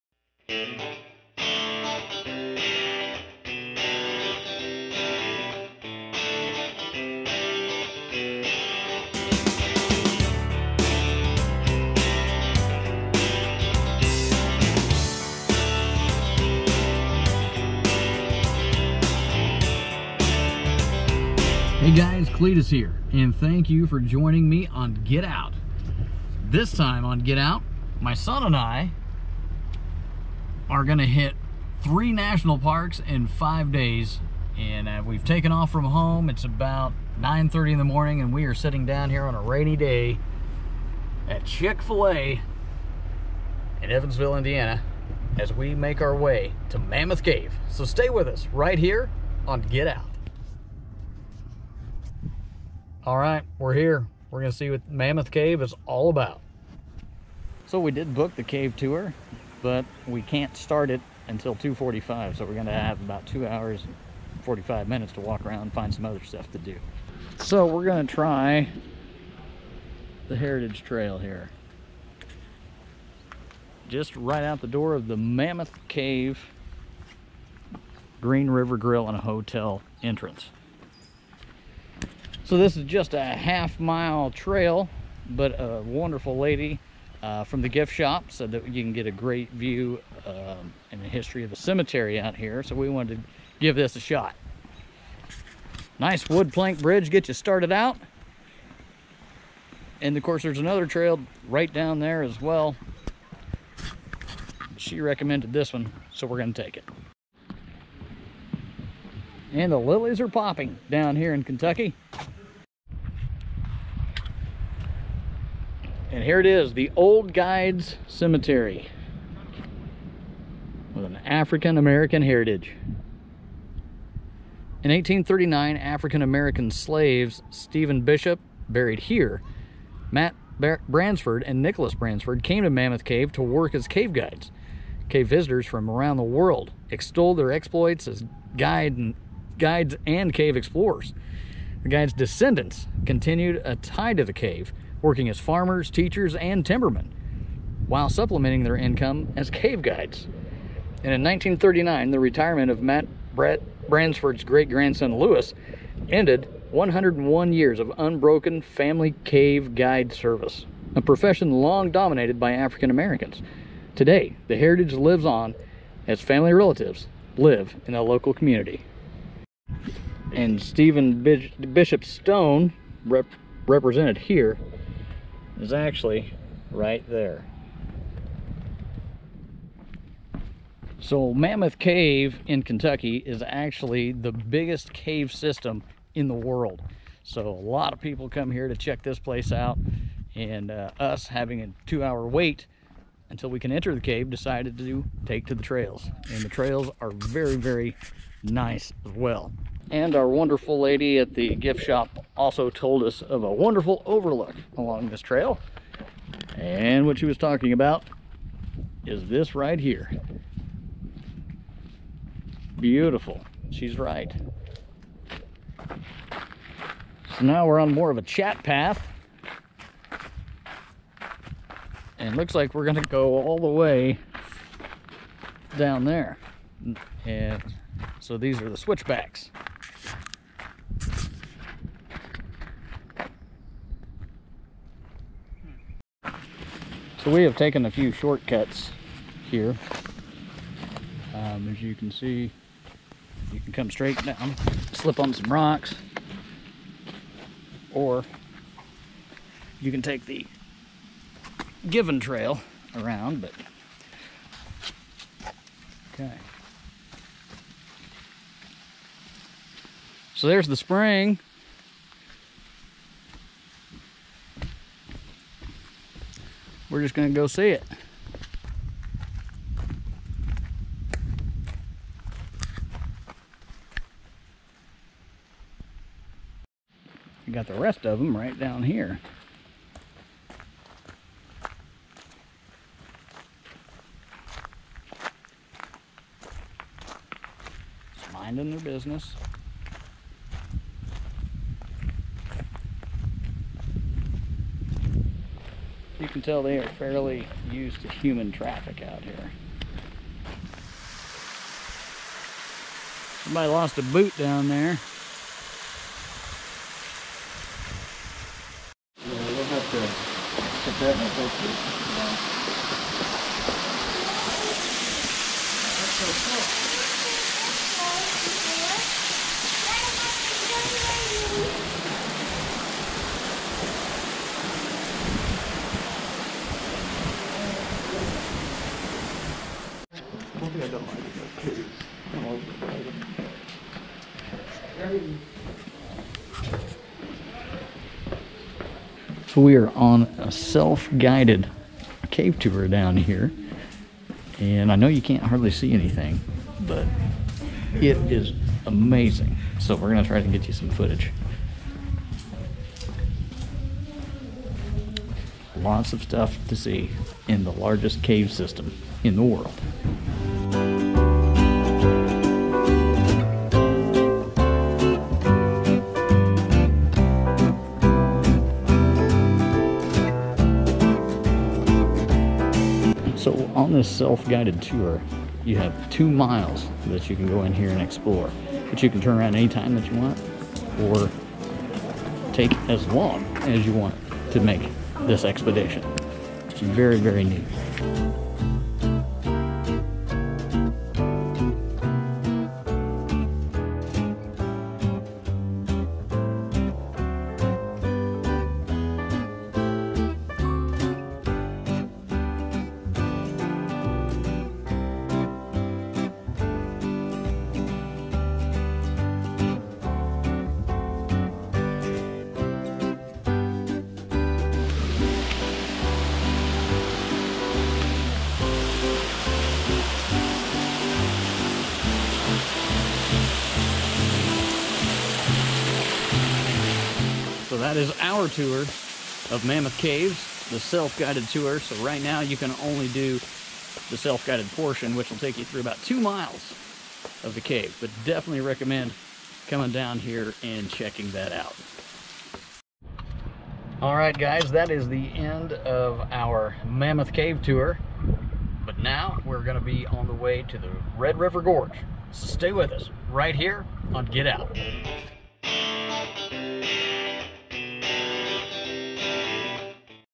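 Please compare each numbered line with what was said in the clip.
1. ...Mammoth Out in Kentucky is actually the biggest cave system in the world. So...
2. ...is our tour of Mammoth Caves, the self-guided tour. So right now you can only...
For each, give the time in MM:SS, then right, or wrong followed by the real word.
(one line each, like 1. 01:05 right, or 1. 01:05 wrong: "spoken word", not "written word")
1. 03:01 wrong: "Cave", not "Out"
2. 07:07 right.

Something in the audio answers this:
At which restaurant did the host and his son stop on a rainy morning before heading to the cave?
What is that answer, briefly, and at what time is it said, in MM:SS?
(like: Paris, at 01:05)
Chick-fil-A, at 00:41.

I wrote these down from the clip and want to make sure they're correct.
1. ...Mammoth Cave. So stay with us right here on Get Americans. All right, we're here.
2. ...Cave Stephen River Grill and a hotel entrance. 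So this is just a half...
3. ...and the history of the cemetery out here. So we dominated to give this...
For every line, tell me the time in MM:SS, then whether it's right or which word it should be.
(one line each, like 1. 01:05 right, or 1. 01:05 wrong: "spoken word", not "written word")
1. 00:46 wrong: "Out", not "Americans"
2. 01:15 wrong: "Green", not "Stephen"
3. 01:30 wrong: "wanted", not "dominated".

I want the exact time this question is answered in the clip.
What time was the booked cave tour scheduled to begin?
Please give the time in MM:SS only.
01:01.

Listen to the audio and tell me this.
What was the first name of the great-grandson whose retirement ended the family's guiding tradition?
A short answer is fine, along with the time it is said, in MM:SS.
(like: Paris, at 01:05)
Lewis, at 02:35.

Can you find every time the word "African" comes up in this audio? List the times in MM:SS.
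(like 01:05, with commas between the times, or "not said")
02:01, 02:05, 02:42.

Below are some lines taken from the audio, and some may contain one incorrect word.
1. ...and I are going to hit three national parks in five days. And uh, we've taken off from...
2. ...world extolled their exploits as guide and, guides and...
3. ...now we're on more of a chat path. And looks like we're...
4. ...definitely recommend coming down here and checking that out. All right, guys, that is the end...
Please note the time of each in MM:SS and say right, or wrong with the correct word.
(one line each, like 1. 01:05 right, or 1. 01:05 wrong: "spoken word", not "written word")
1. 00:28 right
2. 02:16 right
3. 03:37 right
4. 07:18 right.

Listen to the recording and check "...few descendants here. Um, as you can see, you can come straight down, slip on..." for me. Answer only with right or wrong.
wrong.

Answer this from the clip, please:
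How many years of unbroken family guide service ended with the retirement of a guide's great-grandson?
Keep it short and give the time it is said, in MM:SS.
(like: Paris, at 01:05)
101, at 02:36.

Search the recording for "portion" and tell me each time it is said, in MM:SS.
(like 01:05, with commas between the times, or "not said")
07:14.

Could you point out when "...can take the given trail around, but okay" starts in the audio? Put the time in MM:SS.
04:09.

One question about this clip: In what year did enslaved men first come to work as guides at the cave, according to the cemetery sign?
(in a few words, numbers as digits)
1839.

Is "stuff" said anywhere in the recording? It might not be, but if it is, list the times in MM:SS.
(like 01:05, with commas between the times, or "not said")
01:06, 05:56.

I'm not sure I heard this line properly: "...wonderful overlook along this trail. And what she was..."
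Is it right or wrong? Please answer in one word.
right.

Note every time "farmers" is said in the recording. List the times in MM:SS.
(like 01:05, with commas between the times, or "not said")
02:25.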